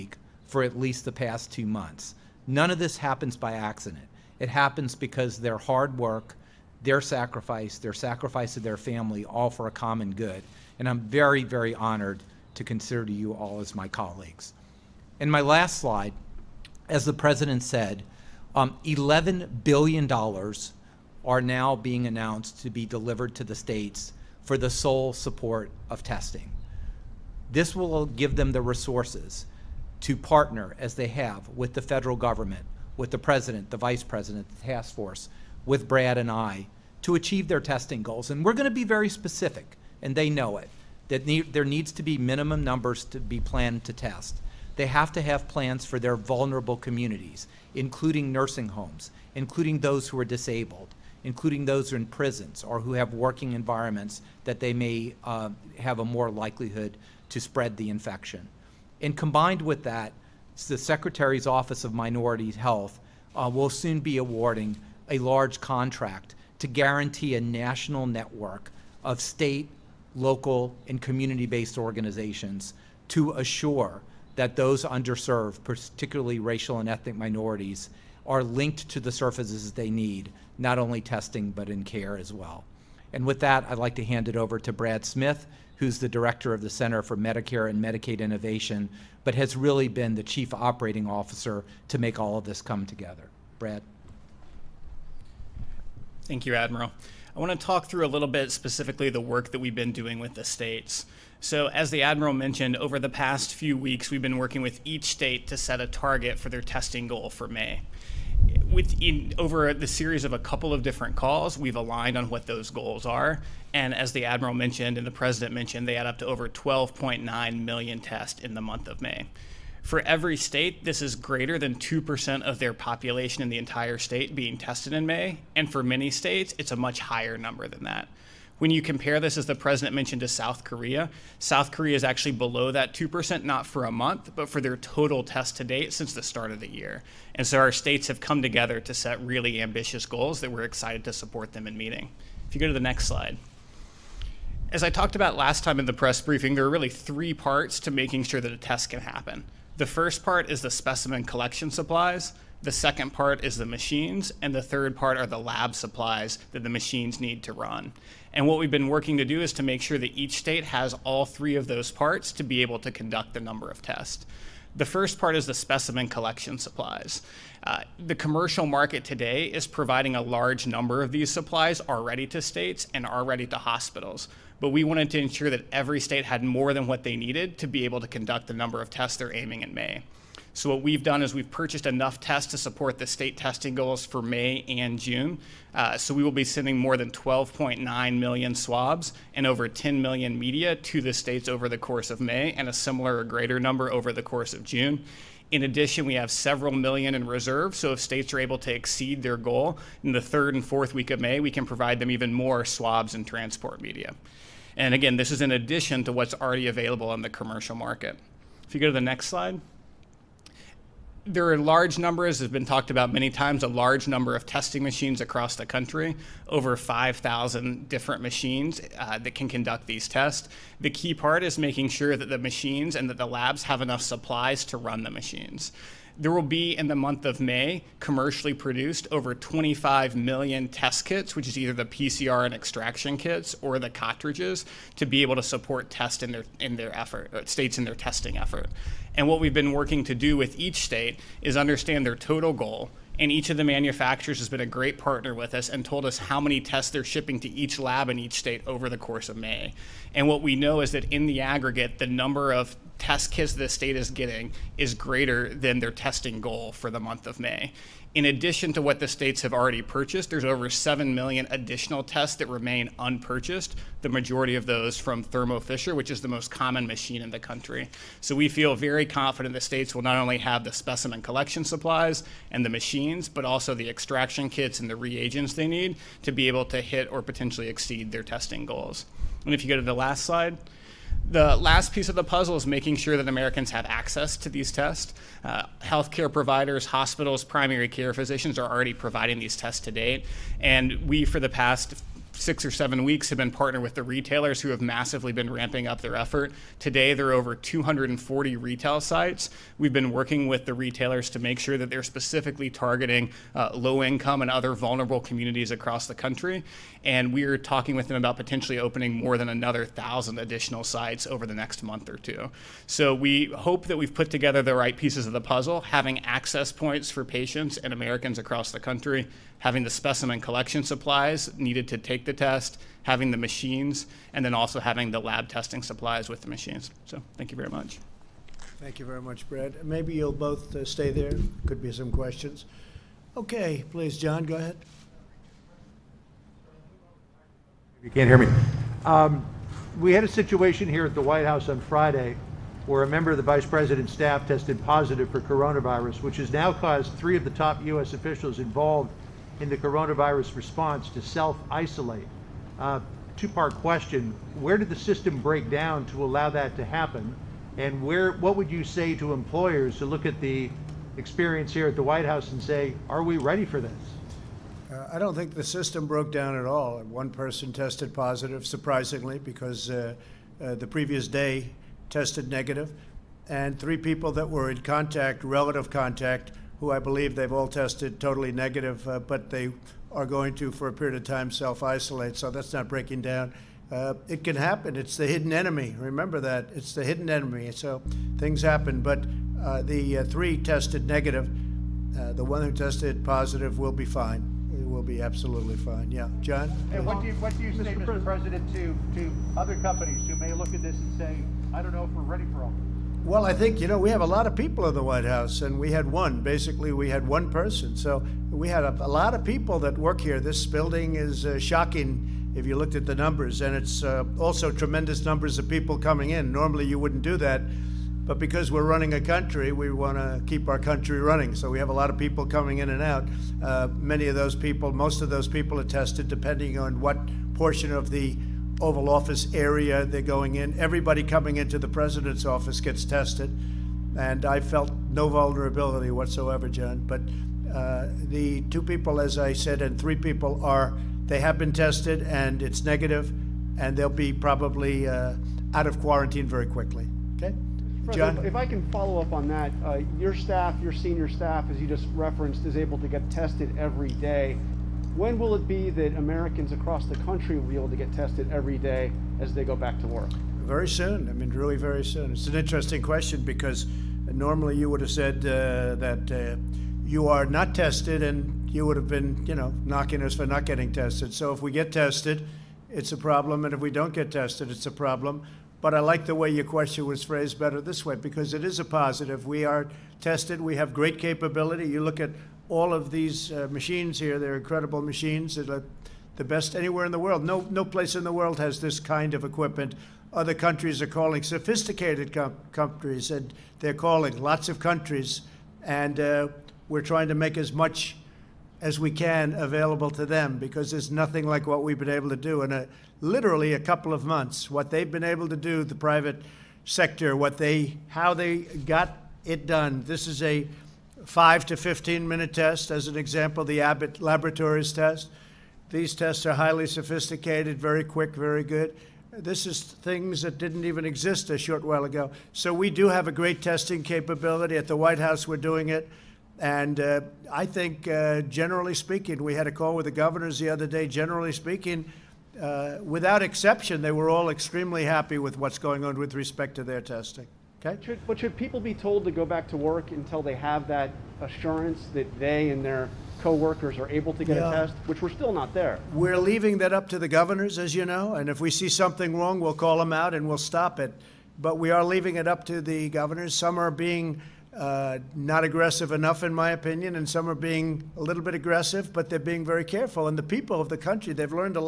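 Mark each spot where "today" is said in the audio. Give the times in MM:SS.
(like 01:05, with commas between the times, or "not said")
02:49, 04:56.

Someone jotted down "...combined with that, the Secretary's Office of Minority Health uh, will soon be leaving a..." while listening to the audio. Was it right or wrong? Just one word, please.
wrong.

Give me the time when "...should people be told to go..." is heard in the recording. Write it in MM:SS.
08:58.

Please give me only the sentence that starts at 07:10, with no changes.
Everybody coming into the president's office gets tested.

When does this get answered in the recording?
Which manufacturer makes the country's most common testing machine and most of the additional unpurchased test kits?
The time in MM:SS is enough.
04:25.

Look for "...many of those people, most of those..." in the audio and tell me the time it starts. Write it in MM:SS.
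07:03.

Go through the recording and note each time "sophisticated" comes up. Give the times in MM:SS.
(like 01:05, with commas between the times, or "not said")
08:11, 08:36.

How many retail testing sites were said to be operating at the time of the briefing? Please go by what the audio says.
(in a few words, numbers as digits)
over 240.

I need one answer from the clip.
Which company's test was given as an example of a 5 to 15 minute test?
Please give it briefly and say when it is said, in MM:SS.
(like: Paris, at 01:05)
Abbott Laboratories, at 08:33.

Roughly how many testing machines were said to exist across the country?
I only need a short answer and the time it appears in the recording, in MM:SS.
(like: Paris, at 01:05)
over 5,000, at 03:36.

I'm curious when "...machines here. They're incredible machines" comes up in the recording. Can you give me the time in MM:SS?
08:03.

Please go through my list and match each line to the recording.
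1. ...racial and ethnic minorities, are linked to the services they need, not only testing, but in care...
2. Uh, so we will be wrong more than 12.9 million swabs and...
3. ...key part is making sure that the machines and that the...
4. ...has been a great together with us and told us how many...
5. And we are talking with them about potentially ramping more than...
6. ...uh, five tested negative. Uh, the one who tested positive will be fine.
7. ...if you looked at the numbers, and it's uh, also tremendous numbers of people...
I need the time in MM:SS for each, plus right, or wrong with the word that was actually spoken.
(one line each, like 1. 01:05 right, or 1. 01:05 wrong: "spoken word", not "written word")
1. 01:16 right
2. 03:05 wrong: "sending", not "wrong"
3. 03:40 right
4. 04:04 wrong: "partner", not "together"
5. 05:07 wrong: "opening", not "ramping"
6. 06:30 wrong: "three", not "five"
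7. 06:52 right.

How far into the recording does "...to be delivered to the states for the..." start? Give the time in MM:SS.
00:22.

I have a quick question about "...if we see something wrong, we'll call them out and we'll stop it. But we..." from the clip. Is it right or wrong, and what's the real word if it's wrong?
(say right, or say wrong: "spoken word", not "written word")
right.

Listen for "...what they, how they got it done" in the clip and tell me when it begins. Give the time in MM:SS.
08:27.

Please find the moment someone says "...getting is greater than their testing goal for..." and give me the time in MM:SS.
04:14.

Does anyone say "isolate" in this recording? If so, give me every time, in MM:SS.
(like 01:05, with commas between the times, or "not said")
05:51, 06:21.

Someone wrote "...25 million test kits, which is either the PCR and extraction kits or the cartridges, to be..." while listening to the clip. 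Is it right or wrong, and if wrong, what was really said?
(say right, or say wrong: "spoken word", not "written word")
right.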